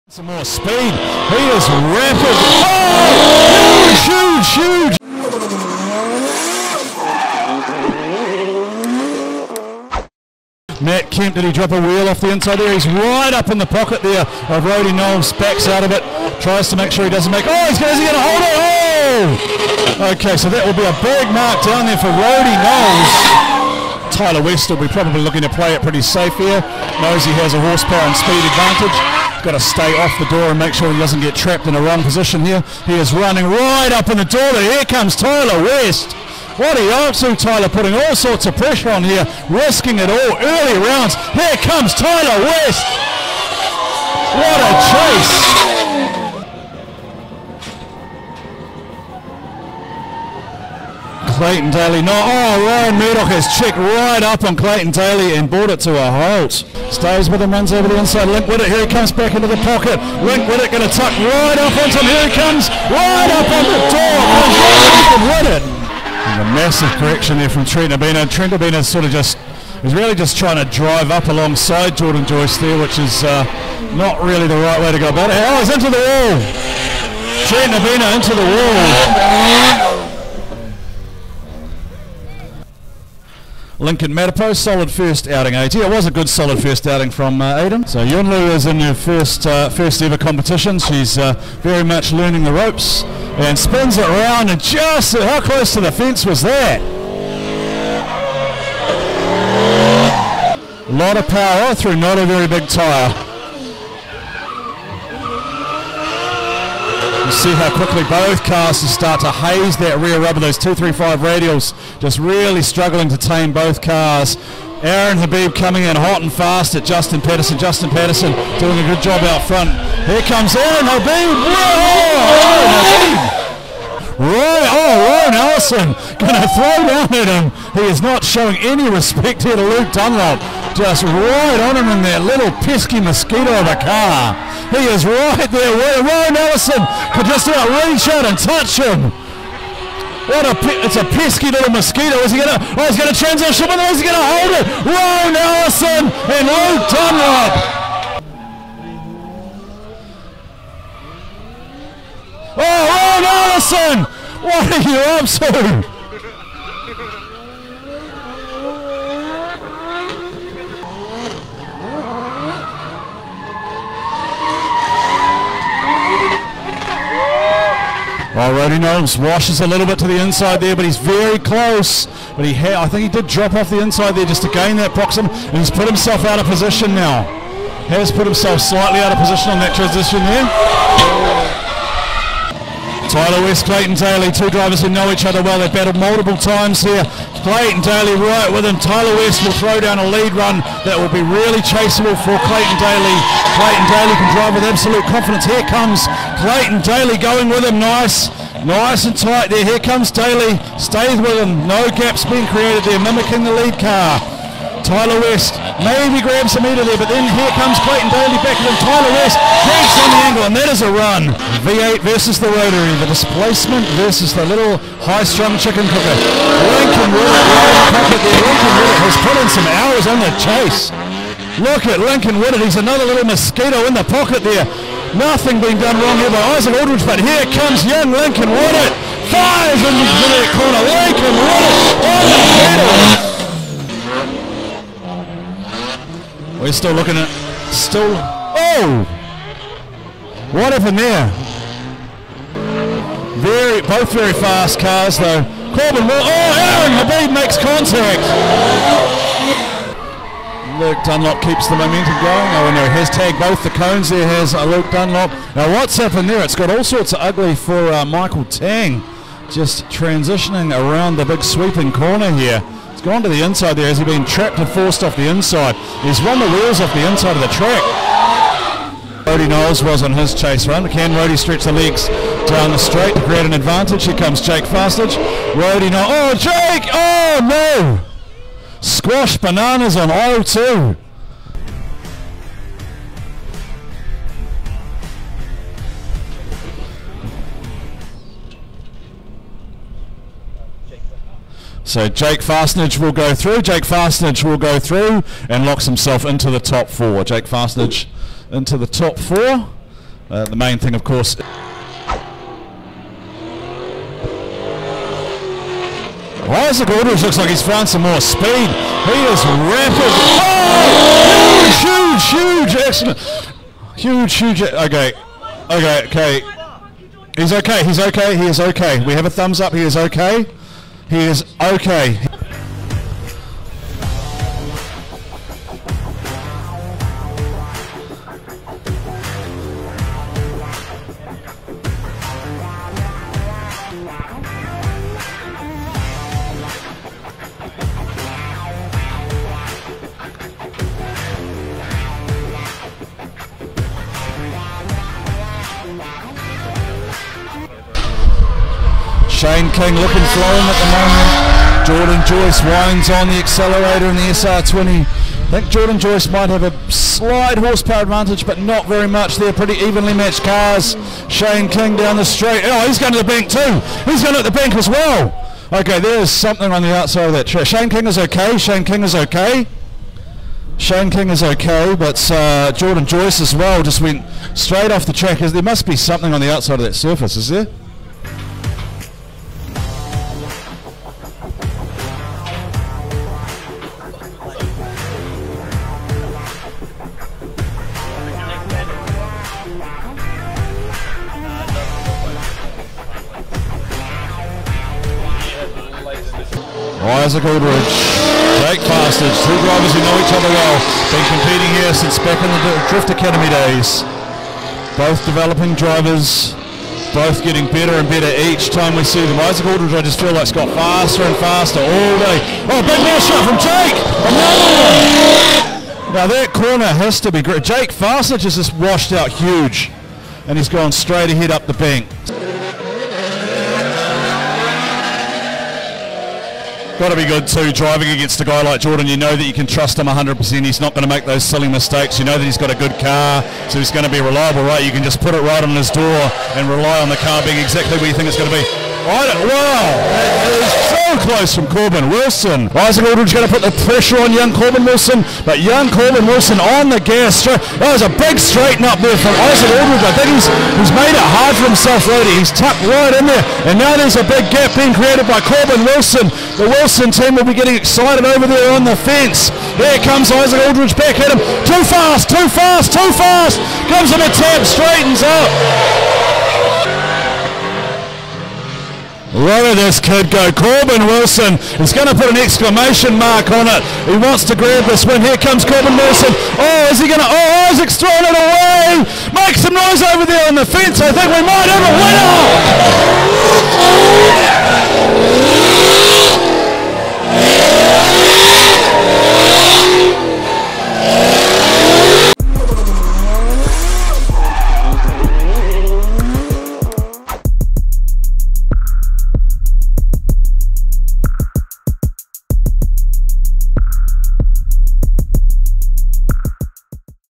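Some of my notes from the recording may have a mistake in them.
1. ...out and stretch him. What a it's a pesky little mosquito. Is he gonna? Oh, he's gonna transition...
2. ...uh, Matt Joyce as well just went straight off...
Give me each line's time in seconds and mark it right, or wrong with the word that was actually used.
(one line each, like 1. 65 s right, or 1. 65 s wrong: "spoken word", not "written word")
1. 138 s wrong: "touch", not "stretch"
2. 372 s wrong: "Jordan", not "Matt".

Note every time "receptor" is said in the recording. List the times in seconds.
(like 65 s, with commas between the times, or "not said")
not said.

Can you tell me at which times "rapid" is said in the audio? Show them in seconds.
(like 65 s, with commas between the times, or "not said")
1 s, 309 s.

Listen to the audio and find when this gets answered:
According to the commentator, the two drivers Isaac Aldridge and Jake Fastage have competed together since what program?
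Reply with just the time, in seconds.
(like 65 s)
402 s.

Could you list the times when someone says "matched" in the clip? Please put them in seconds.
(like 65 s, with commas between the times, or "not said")
360 s.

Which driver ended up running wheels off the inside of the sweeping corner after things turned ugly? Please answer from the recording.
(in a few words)
Michael Tang.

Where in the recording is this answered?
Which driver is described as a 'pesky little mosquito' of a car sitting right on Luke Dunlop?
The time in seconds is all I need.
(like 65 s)
124 s.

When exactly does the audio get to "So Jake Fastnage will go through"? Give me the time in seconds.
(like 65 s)
291 s.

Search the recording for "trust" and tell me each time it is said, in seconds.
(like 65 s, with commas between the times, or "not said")
429 s.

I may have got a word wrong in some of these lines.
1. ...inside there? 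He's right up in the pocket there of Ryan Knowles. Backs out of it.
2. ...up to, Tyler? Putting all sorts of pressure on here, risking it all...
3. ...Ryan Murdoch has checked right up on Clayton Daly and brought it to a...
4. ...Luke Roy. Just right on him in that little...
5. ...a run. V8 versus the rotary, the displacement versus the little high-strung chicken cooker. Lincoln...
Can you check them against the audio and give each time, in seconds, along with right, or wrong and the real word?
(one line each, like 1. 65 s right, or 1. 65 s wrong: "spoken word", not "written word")
1. 12 s wrong: "Roddy", not "Ryan"
2. 36 s right
3. 52 s right
4. 129 s wrong: "Dunlop", not "Roy"
5. 210 s right.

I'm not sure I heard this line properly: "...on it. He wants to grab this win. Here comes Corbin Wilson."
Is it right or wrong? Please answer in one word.
right.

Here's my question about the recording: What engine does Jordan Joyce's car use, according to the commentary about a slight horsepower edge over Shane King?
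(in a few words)
SR20.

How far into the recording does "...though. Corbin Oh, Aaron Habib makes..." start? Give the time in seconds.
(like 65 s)
245 s.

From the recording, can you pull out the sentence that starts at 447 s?
That was a big straighten up there from Isaac Aldridge.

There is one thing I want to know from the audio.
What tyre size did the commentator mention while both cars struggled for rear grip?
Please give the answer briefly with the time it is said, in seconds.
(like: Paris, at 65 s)
235, at 110 s.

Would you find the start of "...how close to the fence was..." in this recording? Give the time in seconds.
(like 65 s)
95 s.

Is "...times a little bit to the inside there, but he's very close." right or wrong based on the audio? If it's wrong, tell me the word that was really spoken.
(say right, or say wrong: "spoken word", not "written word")
wrong: "washes", not "times".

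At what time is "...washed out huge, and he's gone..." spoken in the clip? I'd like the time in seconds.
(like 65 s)
418 s.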